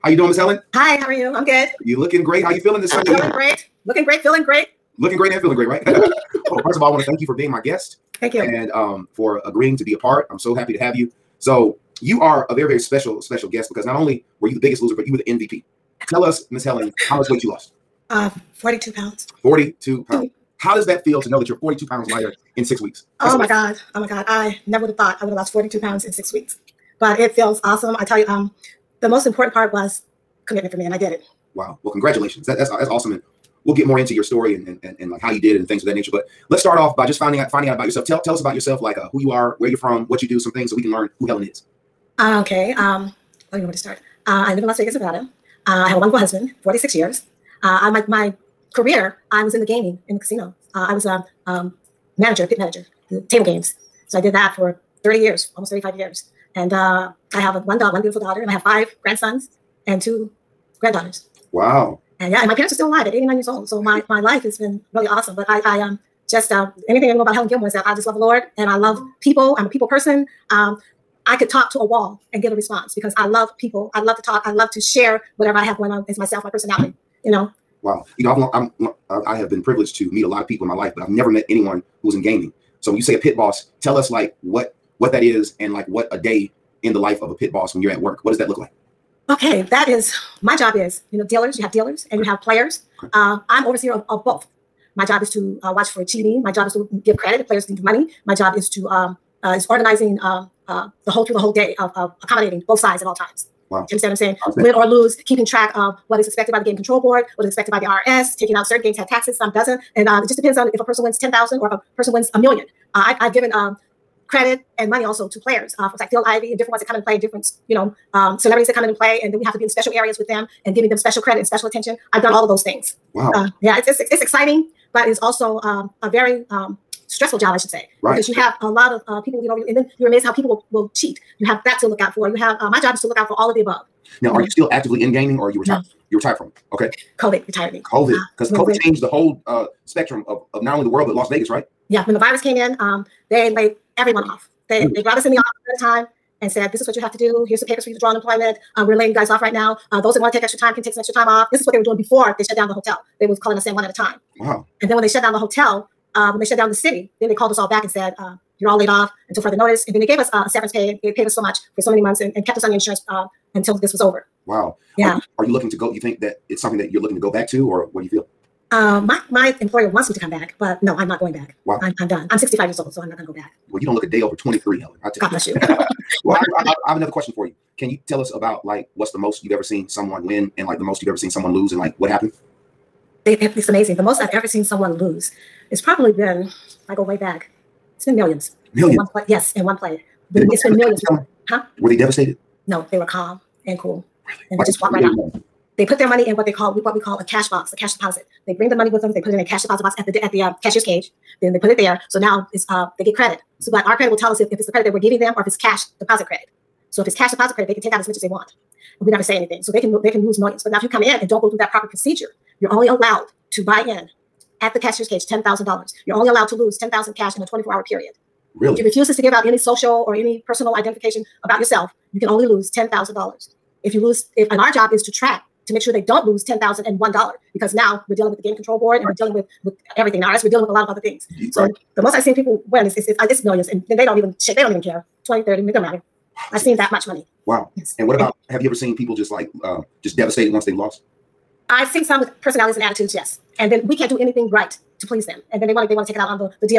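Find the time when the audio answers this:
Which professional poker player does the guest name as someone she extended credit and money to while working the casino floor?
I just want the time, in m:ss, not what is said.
1:56.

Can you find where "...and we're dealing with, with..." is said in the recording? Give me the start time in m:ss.
3:48.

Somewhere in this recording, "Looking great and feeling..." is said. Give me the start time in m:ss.
0:04.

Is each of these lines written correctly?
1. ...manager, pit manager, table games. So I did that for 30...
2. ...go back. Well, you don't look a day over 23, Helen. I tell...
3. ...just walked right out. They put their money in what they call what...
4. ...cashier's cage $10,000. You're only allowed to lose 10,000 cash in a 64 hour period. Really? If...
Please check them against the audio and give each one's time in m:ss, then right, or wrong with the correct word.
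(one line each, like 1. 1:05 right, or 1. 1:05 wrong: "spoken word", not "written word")
1. 0:52 right
2. 2:53 right
3. 3:14 right
4. 3:34 wrong: "24", not "64".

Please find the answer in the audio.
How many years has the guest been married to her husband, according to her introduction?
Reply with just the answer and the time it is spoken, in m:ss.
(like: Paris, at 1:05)
46, at 0:46.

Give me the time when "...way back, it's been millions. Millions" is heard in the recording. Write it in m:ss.
3:07.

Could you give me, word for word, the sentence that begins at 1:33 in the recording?
Uh, I'm overseer of, of both.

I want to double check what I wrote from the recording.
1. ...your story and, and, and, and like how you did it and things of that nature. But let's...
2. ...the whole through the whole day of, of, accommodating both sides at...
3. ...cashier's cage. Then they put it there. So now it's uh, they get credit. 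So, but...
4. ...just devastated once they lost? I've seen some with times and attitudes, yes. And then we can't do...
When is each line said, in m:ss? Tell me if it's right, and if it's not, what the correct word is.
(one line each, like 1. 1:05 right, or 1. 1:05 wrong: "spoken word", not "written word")
1. 0:34 right
2. 1:41 right
3. 3:20 right
4. 4:00 wrong: "personalities", not "times".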